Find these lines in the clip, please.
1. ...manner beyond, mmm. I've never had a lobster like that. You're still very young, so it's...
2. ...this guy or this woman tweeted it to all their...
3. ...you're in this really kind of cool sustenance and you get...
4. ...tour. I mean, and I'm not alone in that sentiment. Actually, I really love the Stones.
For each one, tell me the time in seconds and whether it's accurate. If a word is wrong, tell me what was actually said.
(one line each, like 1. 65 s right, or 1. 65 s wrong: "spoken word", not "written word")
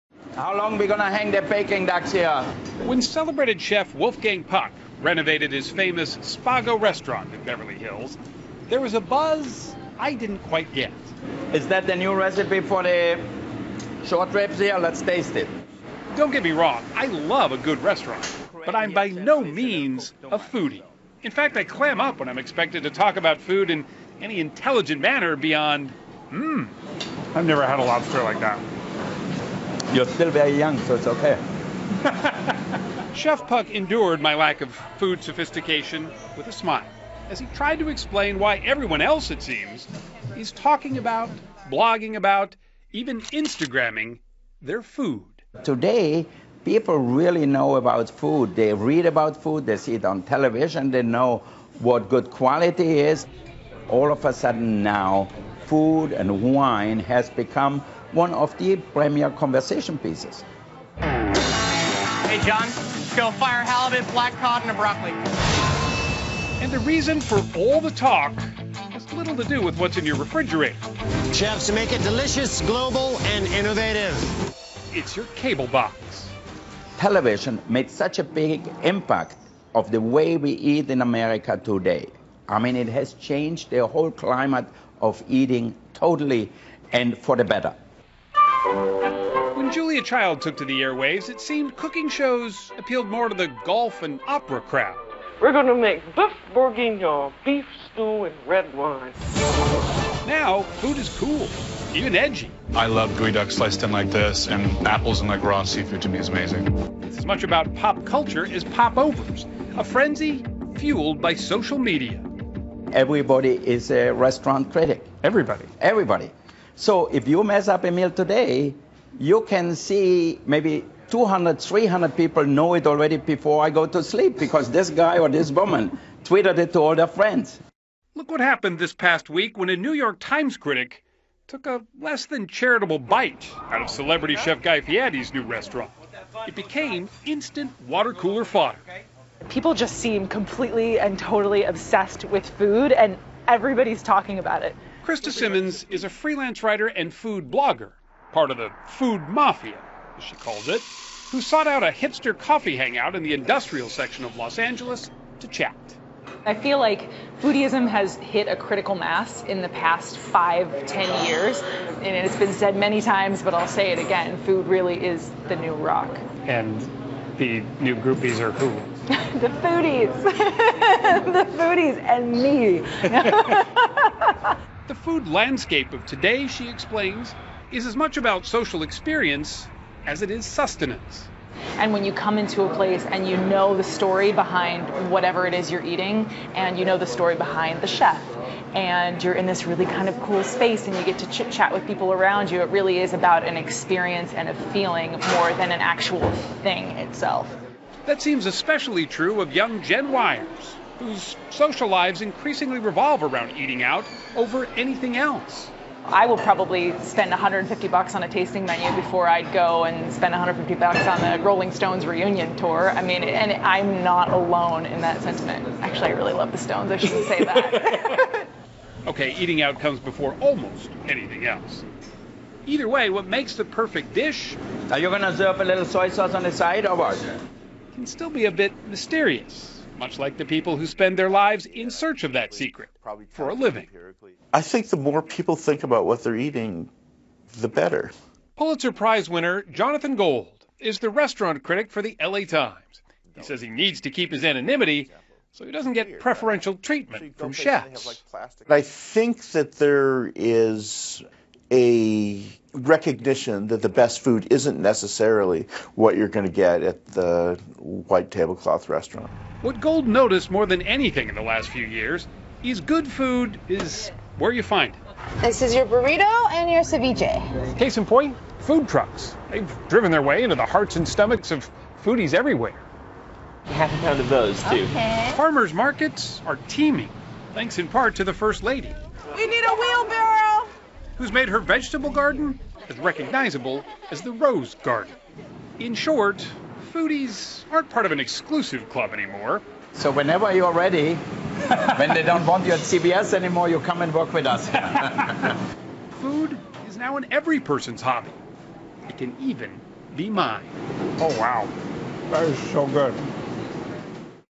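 1. 25 s right
2. 124 s right
3. 189 s wrong: "space", not "sustenance"
4. 212 s right.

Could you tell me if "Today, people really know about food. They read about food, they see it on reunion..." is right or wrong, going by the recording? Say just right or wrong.
wrong.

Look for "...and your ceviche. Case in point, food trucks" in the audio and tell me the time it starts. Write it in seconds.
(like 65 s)
266 s.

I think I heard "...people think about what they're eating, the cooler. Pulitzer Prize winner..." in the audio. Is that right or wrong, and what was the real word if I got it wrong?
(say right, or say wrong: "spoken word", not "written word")
wrong: "better", not "cooler".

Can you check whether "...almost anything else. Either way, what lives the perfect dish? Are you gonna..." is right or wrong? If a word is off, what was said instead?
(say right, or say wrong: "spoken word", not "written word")
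wrong: "makes", not "lives".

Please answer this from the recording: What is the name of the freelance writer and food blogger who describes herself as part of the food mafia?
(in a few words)
Krista Simmons.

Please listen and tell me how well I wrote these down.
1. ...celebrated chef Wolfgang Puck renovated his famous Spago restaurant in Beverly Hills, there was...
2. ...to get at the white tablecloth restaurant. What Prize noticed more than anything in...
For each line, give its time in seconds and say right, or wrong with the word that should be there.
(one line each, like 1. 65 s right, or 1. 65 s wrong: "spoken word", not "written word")
1. 3 s right
2. 256 s wrong: "Gold", not "Prize".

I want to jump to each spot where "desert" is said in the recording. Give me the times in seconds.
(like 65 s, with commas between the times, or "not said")
not said.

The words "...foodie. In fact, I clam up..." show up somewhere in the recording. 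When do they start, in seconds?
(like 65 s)
20 s.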